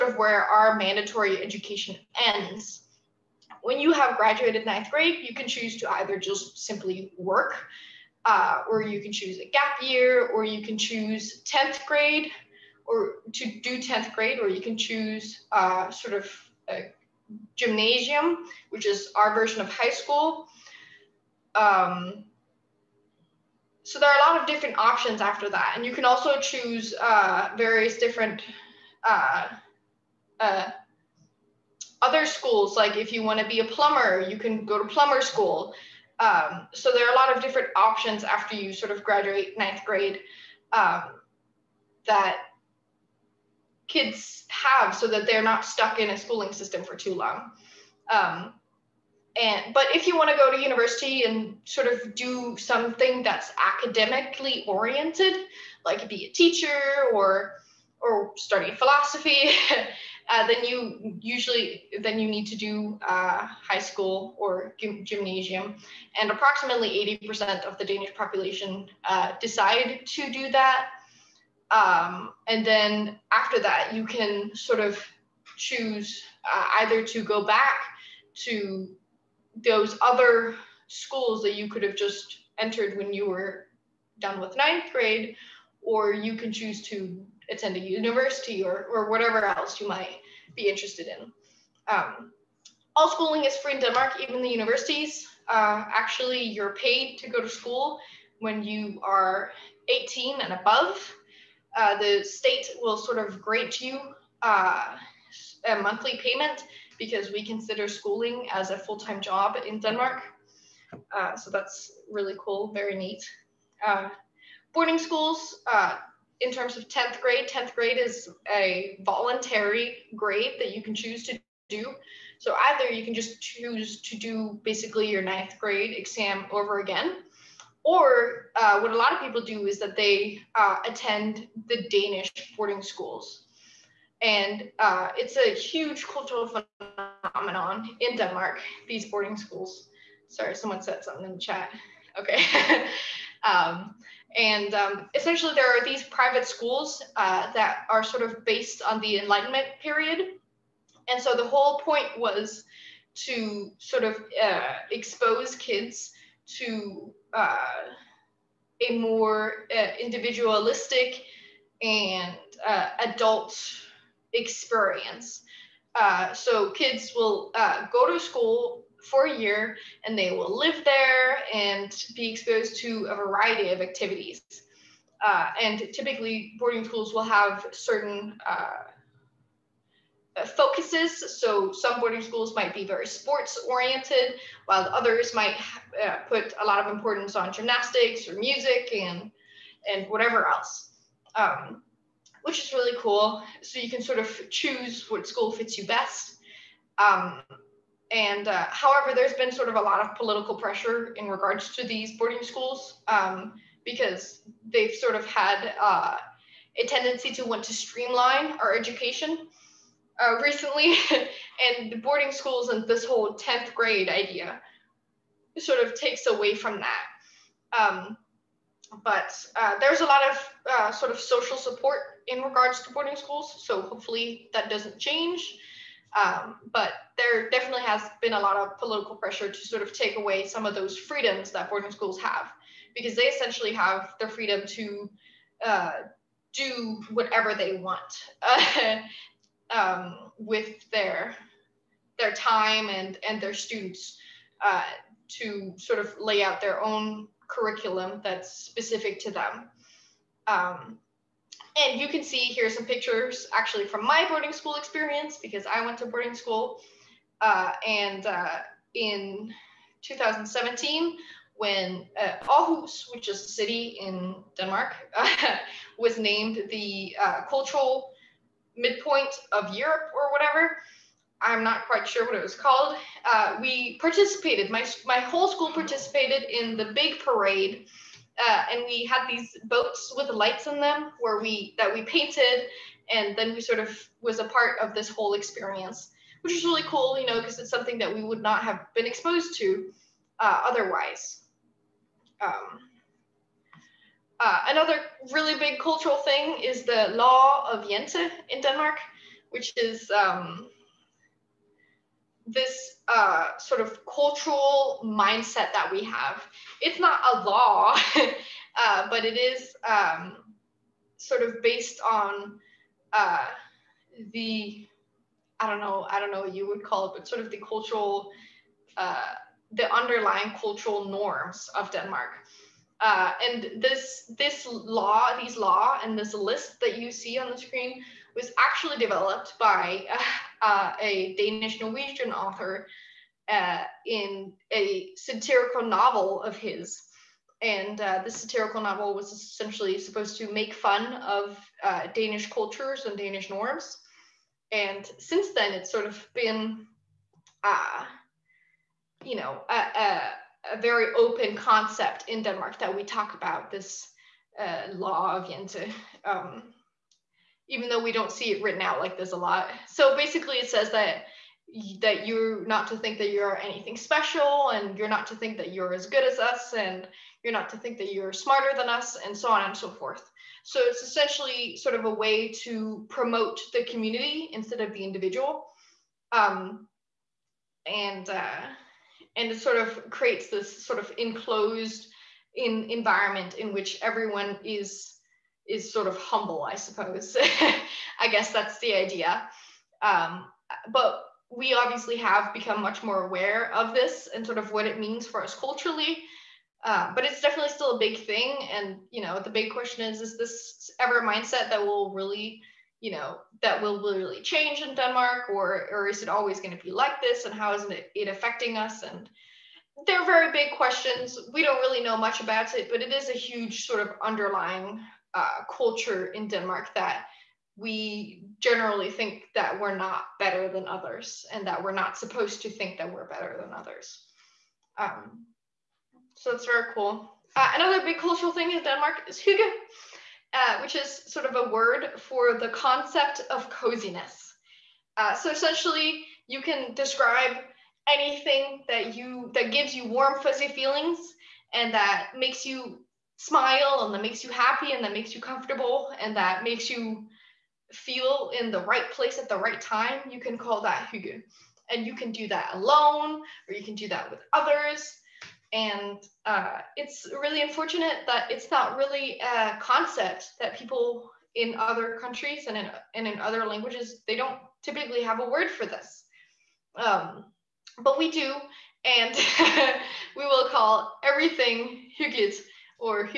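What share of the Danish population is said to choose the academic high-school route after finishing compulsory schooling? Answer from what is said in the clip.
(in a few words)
80%.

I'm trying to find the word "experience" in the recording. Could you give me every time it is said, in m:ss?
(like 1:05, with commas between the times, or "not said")
2:44, 4:14, 4:45.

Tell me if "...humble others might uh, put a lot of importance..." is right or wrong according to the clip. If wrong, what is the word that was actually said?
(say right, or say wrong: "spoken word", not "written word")
wrong: "while", not "humble".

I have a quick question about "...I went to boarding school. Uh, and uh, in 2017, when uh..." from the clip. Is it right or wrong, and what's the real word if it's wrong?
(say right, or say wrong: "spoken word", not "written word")
right.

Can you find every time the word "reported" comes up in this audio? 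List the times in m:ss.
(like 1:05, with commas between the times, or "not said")
not said.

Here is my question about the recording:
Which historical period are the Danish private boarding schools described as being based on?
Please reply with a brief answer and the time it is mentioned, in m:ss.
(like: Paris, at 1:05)
The Enlightenment, at 2:28.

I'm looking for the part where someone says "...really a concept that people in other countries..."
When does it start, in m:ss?
7:38.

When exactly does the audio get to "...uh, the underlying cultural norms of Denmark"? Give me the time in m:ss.
5:18.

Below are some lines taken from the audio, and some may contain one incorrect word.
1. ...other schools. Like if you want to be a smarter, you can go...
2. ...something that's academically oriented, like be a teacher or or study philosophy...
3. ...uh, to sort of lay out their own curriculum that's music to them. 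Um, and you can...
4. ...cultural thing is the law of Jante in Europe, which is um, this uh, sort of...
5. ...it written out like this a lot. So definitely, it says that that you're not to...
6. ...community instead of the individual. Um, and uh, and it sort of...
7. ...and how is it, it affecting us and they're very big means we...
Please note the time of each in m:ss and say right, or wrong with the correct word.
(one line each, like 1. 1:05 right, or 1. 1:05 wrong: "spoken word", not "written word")
1. 0:32 wrong: "plumber", not "smarter"
2. 0:52 right
3. 4:04 wrong: "specific", not "music"
4. 4:55 wrong: "Denmark", not "Europe"
5. 5:58 wrong: "basically", not "definitely"
6. 6:13 right
7. 6:47 wrong: "questions", not "means".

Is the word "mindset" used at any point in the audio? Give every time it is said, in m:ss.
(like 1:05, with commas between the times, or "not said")
5:05, 6:41.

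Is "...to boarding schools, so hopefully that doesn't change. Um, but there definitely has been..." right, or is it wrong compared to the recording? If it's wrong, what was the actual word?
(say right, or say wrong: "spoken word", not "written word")
right.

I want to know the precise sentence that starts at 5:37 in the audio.
And uh, this satirical novel was essentially supposed to make fun of uh, Danish cultures and Danish norms.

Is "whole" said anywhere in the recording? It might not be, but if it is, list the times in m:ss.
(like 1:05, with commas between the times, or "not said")
2:31, 3:33, 4:35, 4:45.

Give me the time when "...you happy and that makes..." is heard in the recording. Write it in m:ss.
7:24.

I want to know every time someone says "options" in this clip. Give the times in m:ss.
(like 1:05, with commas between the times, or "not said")
0:24, 0:37.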